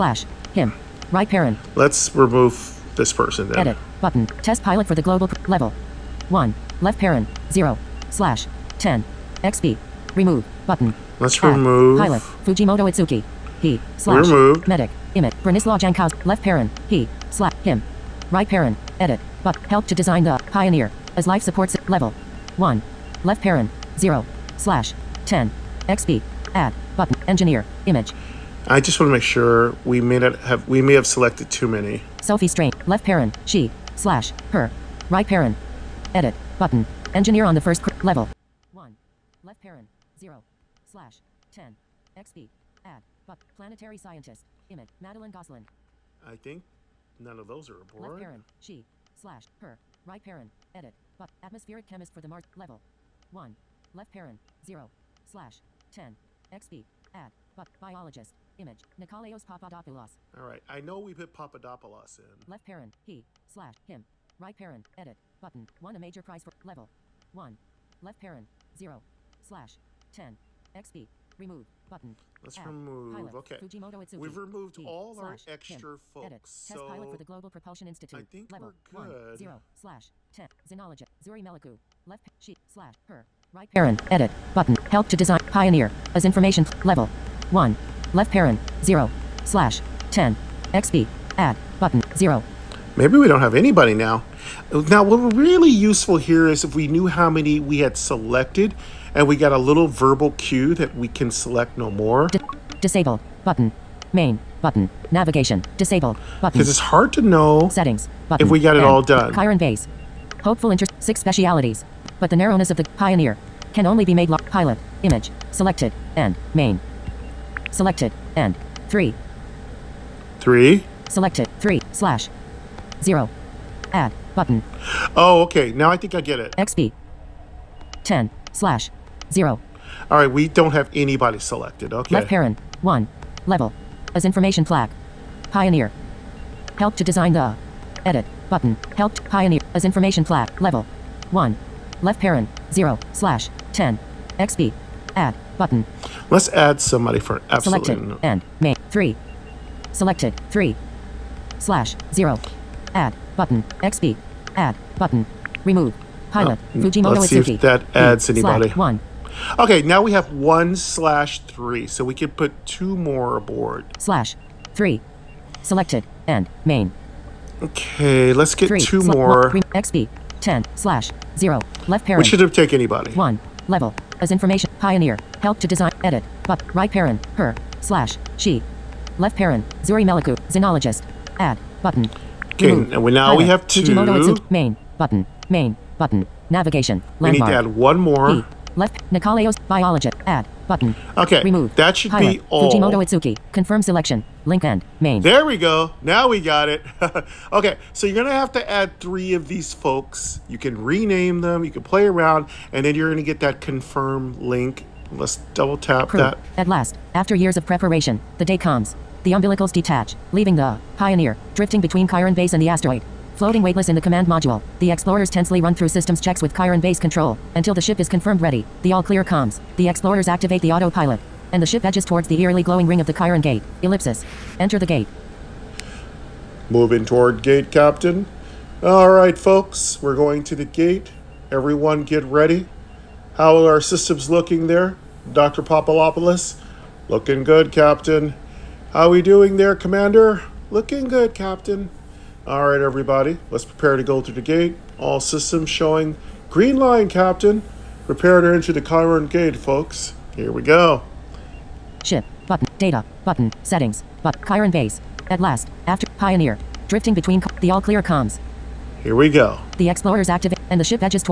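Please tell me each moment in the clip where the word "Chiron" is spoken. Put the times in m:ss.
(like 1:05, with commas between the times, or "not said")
1:49, 3:32, 3:36, 3:43, 4:08, 4:14.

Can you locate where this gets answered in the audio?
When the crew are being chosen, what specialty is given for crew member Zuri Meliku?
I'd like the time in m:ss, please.
3:00.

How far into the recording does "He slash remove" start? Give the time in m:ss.
0:13.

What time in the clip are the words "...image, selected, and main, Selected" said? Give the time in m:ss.
1:55.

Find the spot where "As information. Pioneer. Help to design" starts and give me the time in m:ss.
2:54.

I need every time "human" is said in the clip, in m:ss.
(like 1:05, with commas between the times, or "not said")
not said.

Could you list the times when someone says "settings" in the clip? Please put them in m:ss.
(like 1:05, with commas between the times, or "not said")
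1:47, 4:13.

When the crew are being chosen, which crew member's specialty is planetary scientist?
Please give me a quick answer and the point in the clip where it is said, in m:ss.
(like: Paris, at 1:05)
Madeline Goslin, at 0:44.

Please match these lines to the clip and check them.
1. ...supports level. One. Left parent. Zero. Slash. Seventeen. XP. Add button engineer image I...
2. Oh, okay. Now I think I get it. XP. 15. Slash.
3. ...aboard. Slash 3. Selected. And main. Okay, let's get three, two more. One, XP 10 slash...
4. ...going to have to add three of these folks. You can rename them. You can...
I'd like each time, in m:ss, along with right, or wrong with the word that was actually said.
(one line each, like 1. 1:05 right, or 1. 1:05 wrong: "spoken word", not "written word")
1. 0:21 wrong: "Ten", not "Seventeen"
2. 2:05 wrong: "10", not "15"
3. 2:43 right
4. 3:18 right.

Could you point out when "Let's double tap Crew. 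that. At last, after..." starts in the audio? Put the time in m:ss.
3:25.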